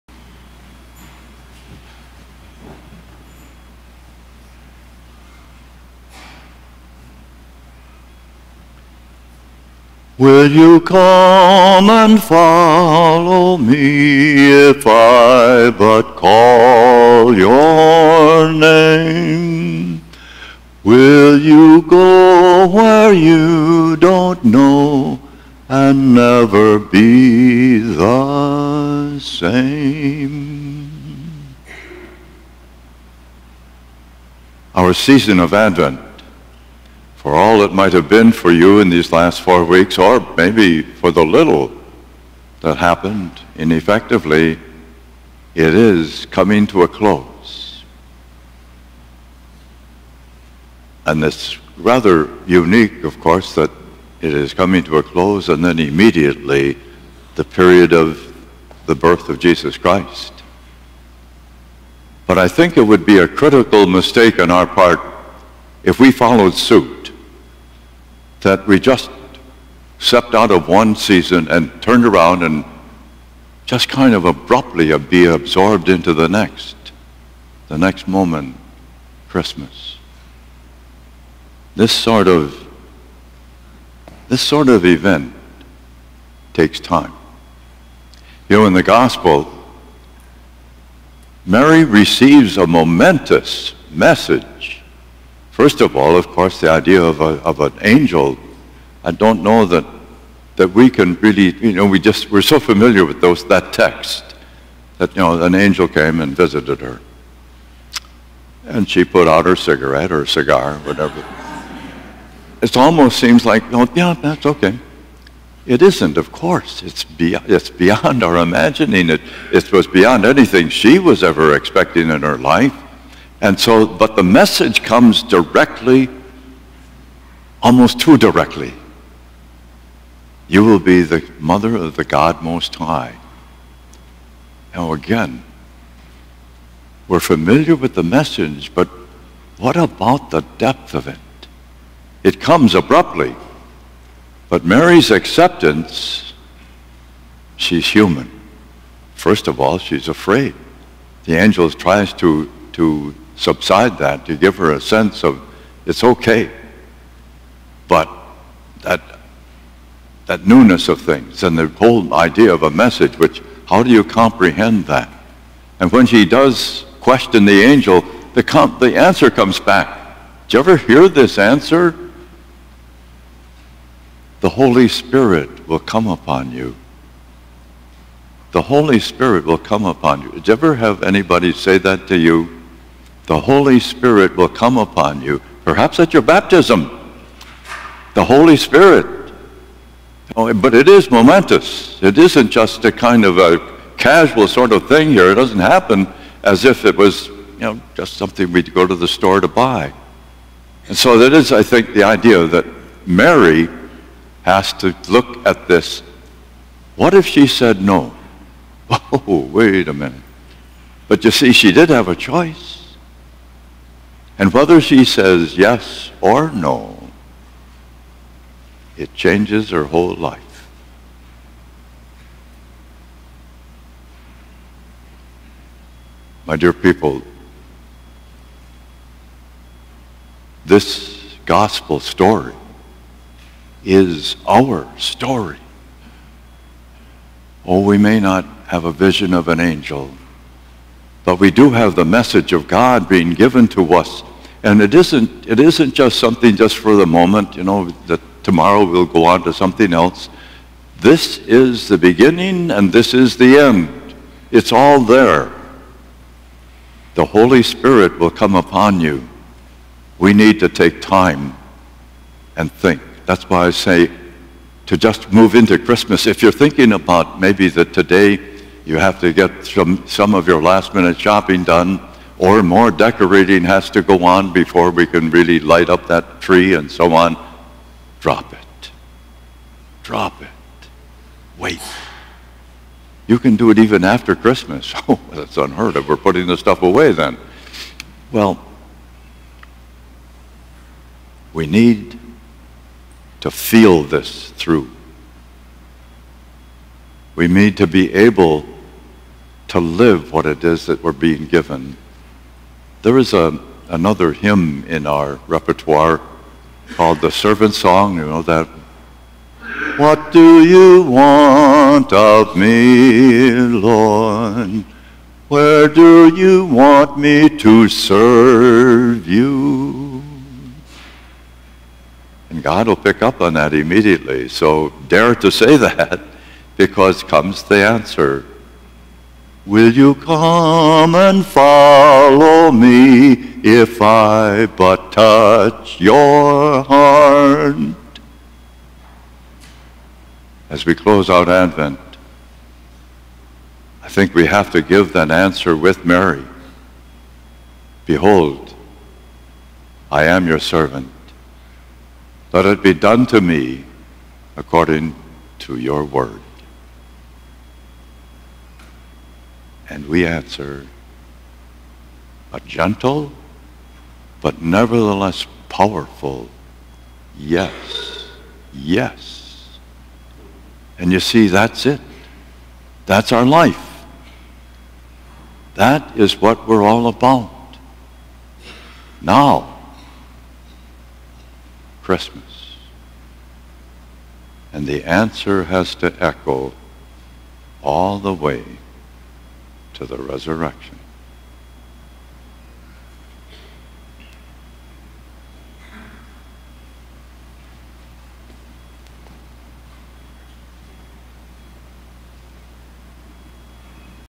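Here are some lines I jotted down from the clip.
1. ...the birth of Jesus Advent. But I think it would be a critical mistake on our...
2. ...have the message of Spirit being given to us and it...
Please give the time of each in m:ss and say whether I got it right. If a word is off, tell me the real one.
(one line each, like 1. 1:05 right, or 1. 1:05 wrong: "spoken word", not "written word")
1. 0:58 wrong: "Christ", not "Advent"
2. 4:01 wrong: "God", not "Spirit".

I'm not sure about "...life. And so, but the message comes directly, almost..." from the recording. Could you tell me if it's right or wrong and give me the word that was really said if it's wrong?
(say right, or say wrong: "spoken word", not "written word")
right.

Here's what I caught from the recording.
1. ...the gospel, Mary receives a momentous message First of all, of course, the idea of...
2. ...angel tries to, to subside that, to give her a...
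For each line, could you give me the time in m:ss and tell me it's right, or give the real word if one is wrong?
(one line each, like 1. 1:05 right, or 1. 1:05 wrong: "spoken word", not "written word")
1. 1:28 right
2. 2:31 right.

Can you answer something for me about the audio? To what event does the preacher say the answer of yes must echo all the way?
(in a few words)
the resurrection.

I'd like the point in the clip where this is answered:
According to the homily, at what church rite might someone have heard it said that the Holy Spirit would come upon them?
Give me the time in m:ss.
3:06.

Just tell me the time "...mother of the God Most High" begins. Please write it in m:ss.
2:11.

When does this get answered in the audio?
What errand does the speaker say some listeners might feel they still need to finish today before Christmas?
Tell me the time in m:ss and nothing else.
4:30.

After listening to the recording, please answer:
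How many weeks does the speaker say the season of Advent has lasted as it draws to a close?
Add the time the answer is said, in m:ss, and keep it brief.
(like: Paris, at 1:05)
4, at 0:39.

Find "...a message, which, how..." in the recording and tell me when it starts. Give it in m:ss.
2:42.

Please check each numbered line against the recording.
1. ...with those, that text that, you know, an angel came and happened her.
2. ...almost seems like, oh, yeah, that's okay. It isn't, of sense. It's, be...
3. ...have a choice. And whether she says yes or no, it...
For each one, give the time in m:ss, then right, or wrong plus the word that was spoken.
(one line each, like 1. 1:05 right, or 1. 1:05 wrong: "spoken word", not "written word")
1. 1:43 wrong: "visited", not "happened"
2. 1:52 wrong: "course", not "sense"
3. 3:31 right.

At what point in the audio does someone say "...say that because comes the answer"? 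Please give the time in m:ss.
5:25.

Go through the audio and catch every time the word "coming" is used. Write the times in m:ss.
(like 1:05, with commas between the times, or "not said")
0:46, 0:54.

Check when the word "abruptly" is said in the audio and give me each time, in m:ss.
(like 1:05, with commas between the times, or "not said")
1:14, 2:22.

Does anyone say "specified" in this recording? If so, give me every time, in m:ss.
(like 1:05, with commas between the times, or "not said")
not said.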